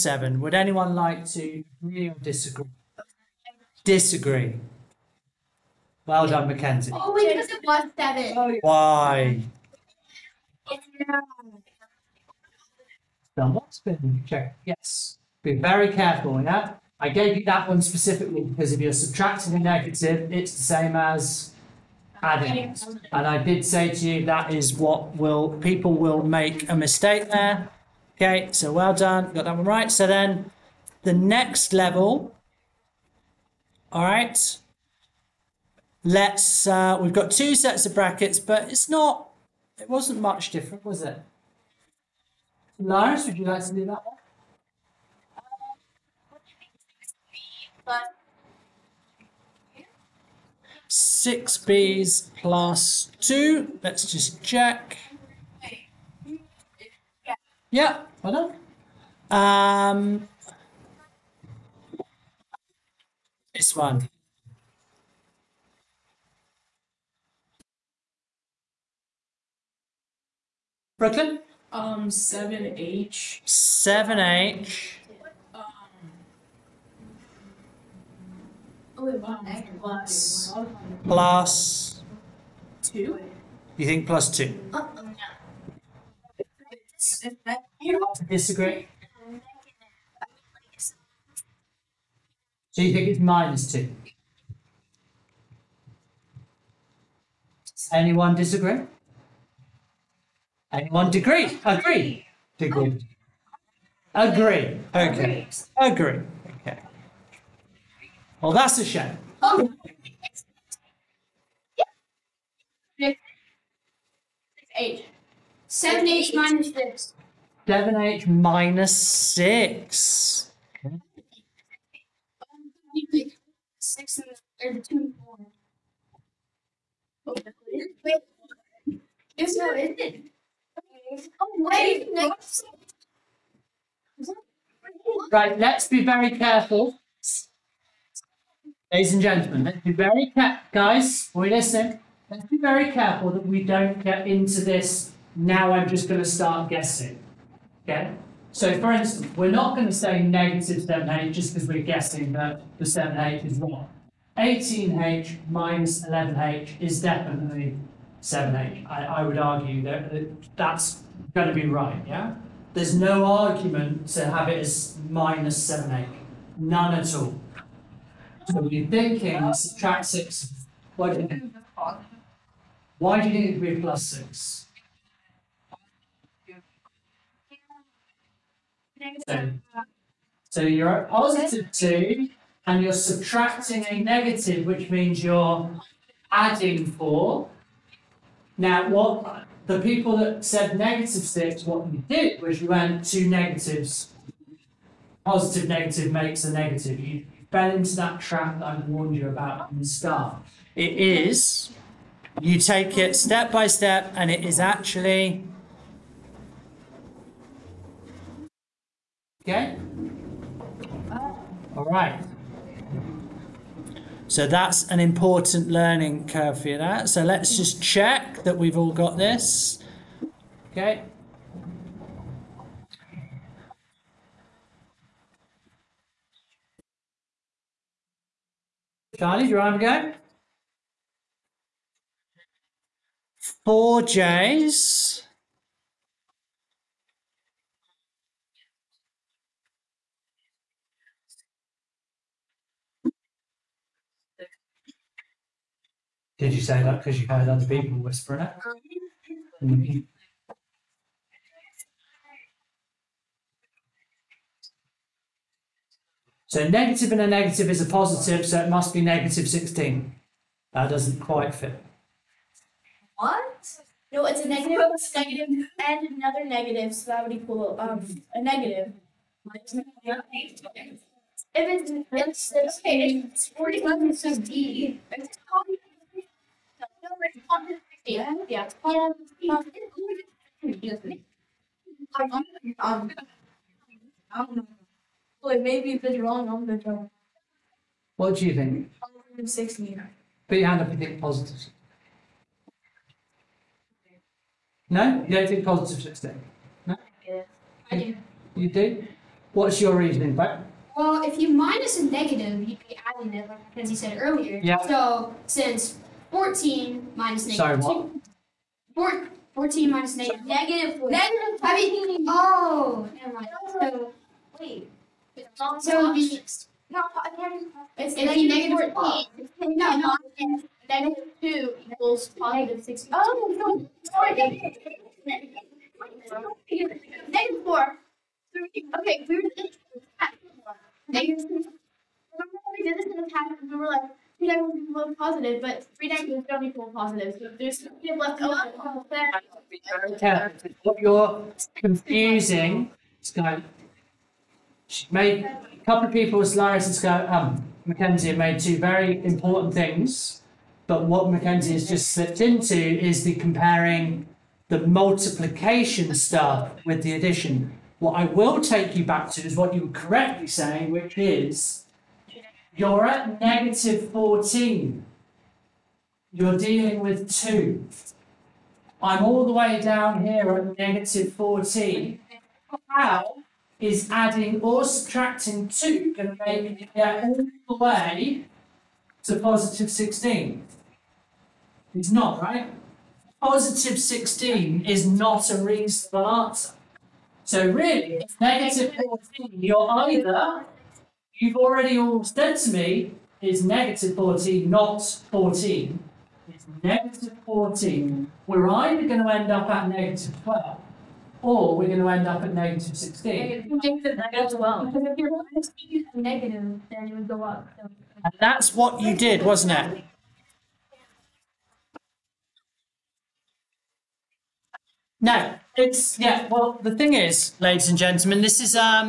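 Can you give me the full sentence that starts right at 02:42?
There's no argument to have it as minus 7h.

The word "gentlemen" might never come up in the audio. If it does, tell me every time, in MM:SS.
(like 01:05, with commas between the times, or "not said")
02:19, 06:57.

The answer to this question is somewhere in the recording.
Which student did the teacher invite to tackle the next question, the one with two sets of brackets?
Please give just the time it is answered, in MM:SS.
00:42.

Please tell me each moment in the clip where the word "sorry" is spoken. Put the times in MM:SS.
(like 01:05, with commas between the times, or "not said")
05:07, 05:24.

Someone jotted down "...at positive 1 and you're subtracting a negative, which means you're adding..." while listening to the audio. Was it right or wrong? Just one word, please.
wrong.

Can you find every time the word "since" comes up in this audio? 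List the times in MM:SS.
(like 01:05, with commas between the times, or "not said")
05:05.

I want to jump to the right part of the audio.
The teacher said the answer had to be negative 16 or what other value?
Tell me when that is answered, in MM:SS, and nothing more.
06:39.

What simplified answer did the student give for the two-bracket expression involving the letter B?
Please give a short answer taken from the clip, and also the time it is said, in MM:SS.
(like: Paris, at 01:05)
6B + 2, at 00:50.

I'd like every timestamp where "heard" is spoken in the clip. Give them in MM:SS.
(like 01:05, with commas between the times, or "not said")
04:07.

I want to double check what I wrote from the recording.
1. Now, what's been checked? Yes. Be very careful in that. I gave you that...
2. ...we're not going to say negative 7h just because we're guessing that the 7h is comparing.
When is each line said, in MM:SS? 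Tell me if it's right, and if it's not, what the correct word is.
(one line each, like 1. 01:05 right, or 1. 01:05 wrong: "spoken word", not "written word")
1. 00:13 right
2. 02:29 wrong: "wrong", not "comparing".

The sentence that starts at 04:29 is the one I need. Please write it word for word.
If it's, it's, it's okay, it's 41, it's just D.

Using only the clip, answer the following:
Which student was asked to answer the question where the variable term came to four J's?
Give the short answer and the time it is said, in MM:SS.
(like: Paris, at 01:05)
Charlie, at 03:49.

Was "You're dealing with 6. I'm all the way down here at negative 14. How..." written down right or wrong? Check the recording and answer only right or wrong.
wrong.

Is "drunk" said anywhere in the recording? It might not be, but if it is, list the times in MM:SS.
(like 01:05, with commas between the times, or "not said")
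04:46.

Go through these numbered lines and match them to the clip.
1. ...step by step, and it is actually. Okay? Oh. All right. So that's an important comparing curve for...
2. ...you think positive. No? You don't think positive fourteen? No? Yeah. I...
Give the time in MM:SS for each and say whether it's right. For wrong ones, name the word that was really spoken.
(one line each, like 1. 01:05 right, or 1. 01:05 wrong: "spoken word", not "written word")
1. 03:23 wrong: "learning", not "comparing"
2. 04:50 wrong: "sixteen", not "fourteen".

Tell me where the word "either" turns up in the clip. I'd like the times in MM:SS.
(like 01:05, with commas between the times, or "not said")
06:30, 06:38.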